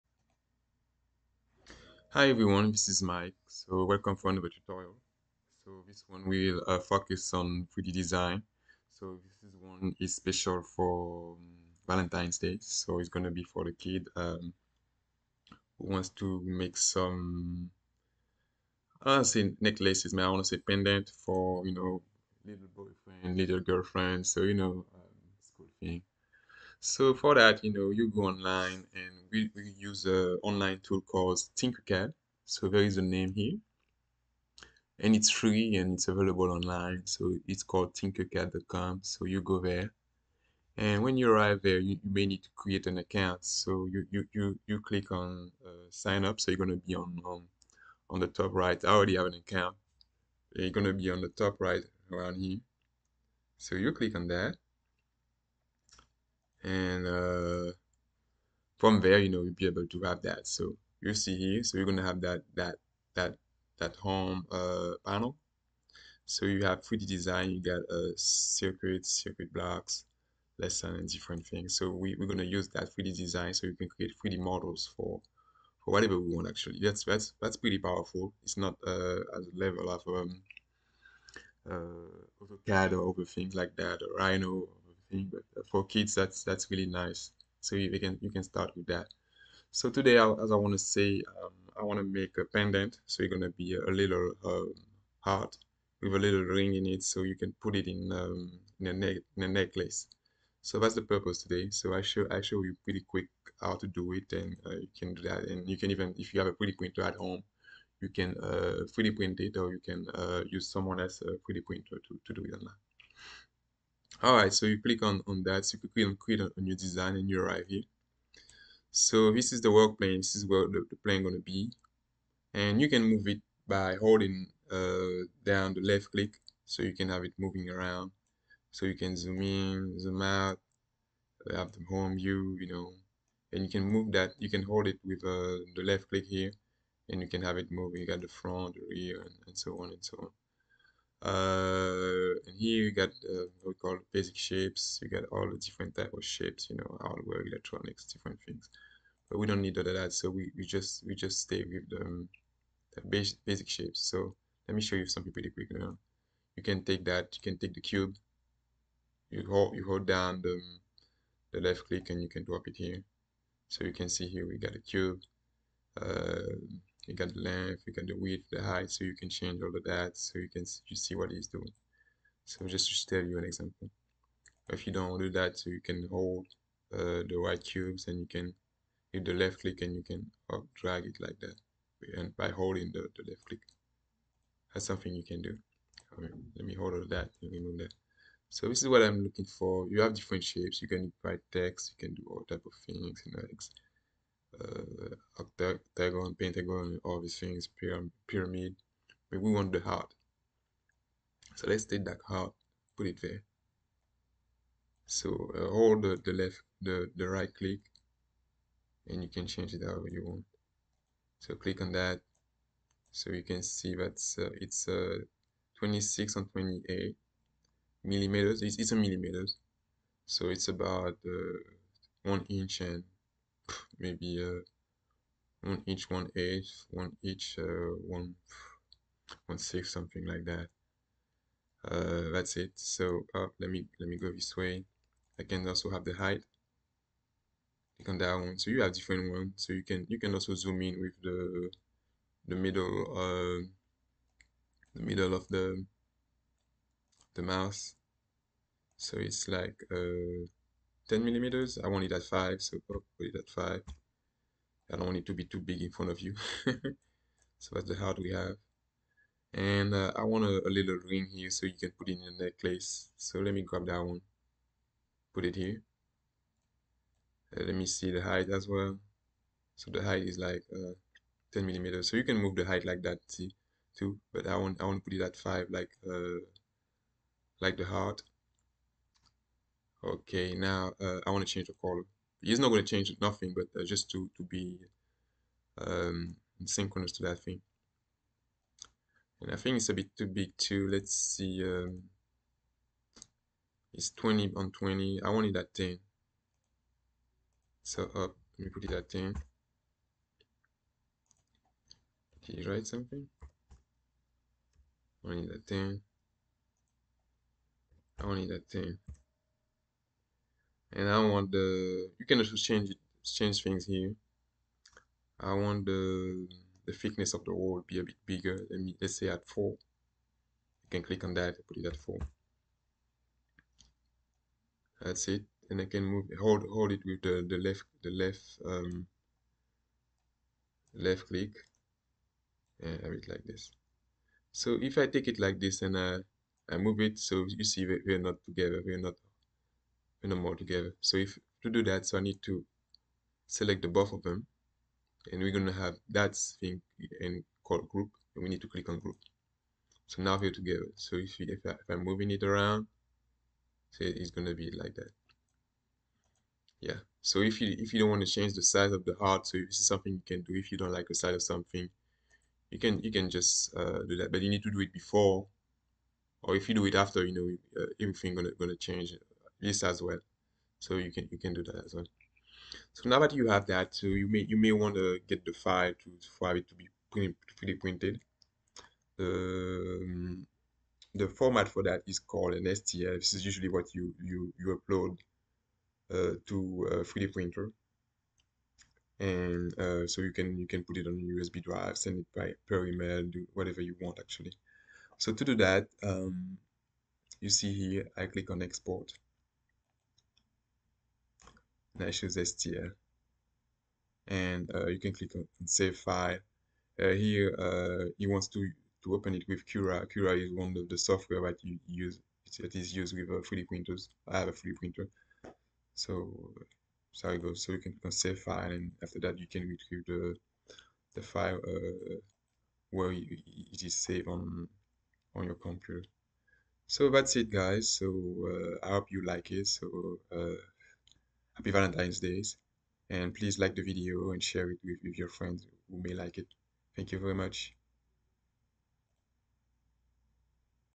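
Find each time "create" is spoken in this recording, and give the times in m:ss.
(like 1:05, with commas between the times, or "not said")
0:42, 1:13, 1:56.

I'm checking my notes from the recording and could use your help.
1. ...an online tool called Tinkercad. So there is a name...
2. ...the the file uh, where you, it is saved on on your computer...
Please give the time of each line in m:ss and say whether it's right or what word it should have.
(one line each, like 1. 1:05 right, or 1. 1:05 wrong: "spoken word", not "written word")
1. 0:30 right
2. 7:00 right.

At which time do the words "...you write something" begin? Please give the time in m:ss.
5:02.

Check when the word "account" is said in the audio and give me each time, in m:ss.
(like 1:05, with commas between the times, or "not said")
0:42, 0:49.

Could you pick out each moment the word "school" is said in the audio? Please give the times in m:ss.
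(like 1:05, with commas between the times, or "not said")
0:25.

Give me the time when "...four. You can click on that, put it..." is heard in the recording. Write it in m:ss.
5:19.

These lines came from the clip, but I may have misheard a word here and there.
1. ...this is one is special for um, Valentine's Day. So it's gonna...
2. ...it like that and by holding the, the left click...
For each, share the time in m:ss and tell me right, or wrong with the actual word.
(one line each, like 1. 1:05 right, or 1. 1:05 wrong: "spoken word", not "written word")
1. 0:09 right
2. 3:01 right.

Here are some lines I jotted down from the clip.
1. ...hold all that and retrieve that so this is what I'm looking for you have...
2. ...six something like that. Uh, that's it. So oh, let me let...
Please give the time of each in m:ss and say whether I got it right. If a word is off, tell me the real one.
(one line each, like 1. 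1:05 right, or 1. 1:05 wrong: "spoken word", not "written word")
1. 3:06 wrong: "remove", not "retrieve"
2. 3:49 right.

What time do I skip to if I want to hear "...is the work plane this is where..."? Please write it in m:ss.
1:59.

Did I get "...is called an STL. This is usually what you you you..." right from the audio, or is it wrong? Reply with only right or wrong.
right.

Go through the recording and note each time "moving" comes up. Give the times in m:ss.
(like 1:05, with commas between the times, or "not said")
2:07, 2:17, 5:52.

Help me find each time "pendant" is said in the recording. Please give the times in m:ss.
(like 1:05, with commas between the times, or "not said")
0:20, 1:32.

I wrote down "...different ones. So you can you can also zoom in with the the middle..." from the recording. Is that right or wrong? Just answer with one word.
right.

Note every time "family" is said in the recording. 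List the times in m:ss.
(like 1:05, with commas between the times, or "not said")
not said.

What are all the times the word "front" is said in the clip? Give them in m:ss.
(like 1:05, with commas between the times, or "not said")
2:18, 4:15.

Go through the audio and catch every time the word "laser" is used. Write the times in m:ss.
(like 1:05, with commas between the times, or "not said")
not said.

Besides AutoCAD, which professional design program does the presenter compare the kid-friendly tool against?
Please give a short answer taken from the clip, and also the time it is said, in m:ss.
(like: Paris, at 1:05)
Rhino, at 1:24.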